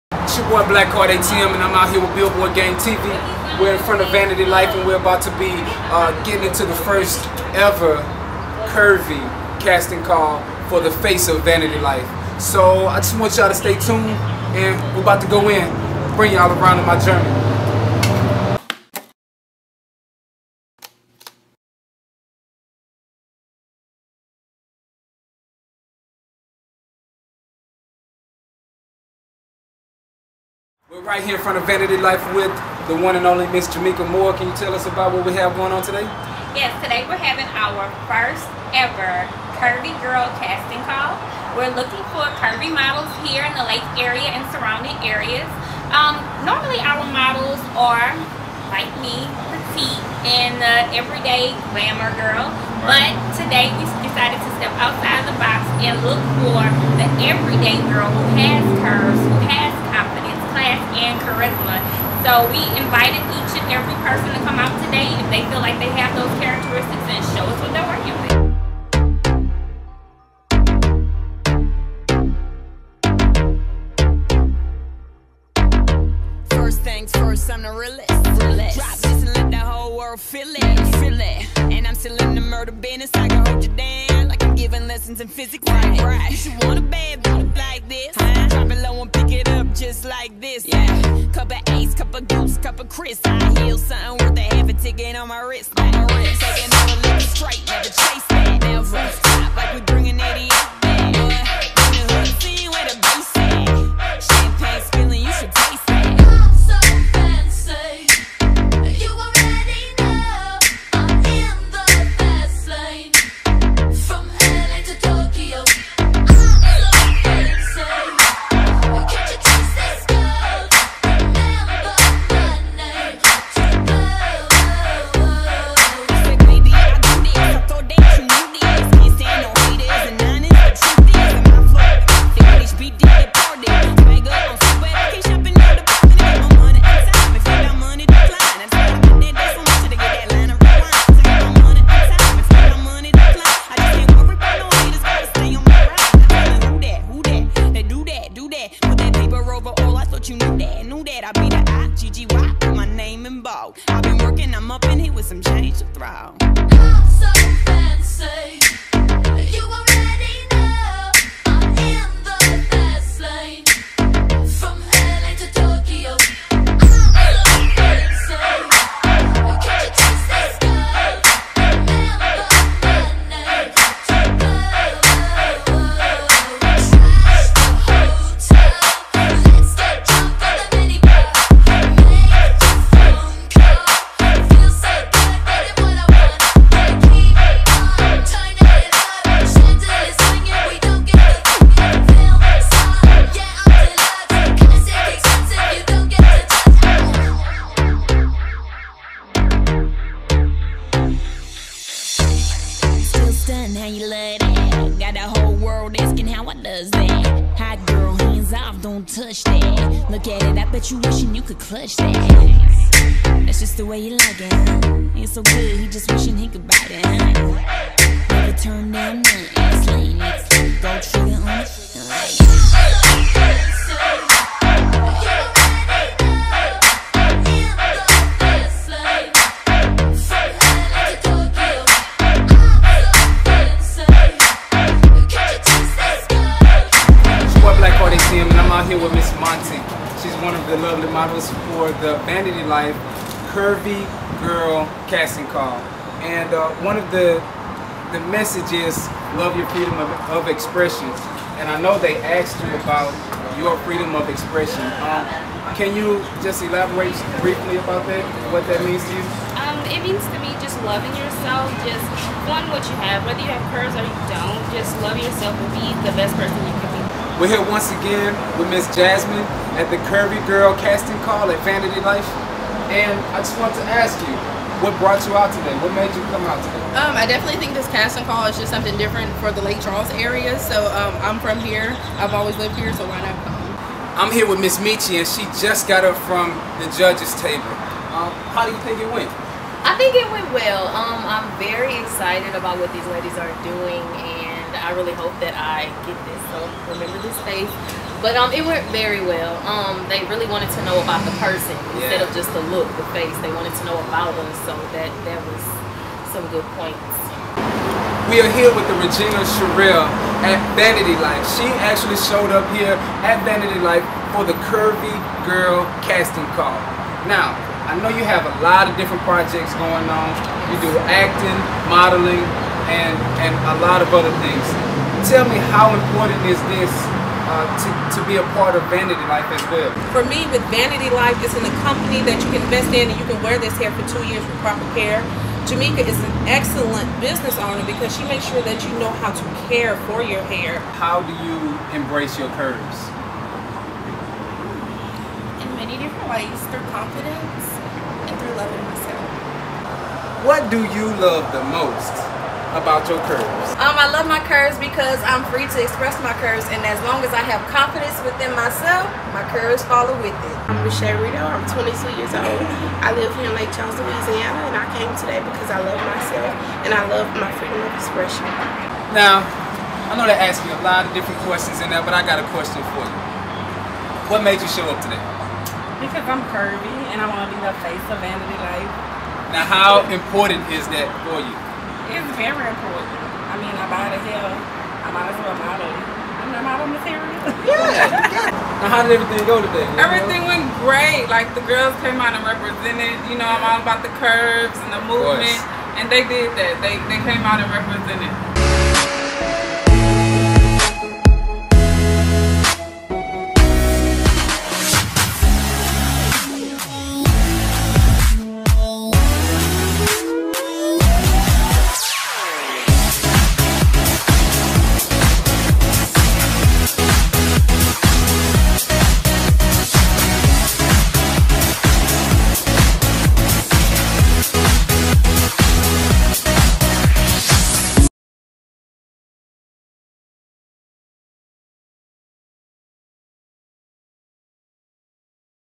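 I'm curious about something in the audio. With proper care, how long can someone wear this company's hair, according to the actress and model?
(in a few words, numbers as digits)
two years.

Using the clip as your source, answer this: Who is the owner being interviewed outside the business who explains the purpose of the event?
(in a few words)
Jamaica Moore.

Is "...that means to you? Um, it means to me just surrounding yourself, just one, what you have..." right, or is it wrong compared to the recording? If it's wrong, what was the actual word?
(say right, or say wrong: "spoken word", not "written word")
wrong: "loving", not "surrounding".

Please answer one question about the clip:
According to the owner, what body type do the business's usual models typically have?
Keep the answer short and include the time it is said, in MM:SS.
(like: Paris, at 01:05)
petite, at 00:49.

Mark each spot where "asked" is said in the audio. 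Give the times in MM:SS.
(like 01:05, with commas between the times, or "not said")
04:12, 06:10.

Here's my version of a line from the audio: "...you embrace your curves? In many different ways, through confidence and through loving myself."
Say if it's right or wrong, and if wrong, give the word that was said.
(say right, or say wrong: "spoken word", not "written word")
right.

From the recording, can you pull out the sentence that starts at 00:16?
Bring y'all around in my journey.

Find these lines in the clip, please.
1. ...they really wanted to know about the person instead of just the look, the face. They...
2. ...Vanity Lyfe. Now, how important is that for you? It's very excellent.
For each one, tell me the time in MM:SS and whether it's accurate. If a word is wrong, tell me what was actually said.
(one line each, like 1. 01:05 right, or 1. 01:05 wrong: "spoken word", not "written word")
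1. 05:00 right
2. 06:18 wrong: "important", not "excellent".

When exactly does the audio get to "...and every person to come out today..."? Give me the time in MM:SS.
01:03.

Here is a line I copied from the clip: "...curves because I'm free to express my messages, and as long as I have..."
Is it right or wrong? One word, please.
wrong.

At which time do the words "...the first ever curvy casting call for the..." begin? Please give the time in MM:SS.
00:06.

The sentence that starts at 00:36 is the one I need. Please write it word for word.
Yes, today we're having our first ever Curvy Girl casting call.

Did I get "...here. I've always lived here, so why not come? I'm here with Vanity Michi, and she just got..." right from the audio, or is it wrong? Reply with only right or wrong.
wrong.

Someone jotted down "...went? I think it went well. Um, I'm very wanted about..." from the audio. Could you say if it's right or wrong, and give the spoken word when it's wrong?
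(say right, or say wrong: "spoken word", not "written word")
wrong: "excited", not "wanted".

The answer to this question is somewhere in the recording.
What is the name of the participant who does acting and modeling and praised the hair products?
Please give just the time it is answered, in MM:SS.
05:09.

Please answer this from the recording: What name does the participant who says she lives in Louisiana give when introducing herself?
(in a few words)
Michelle Rito.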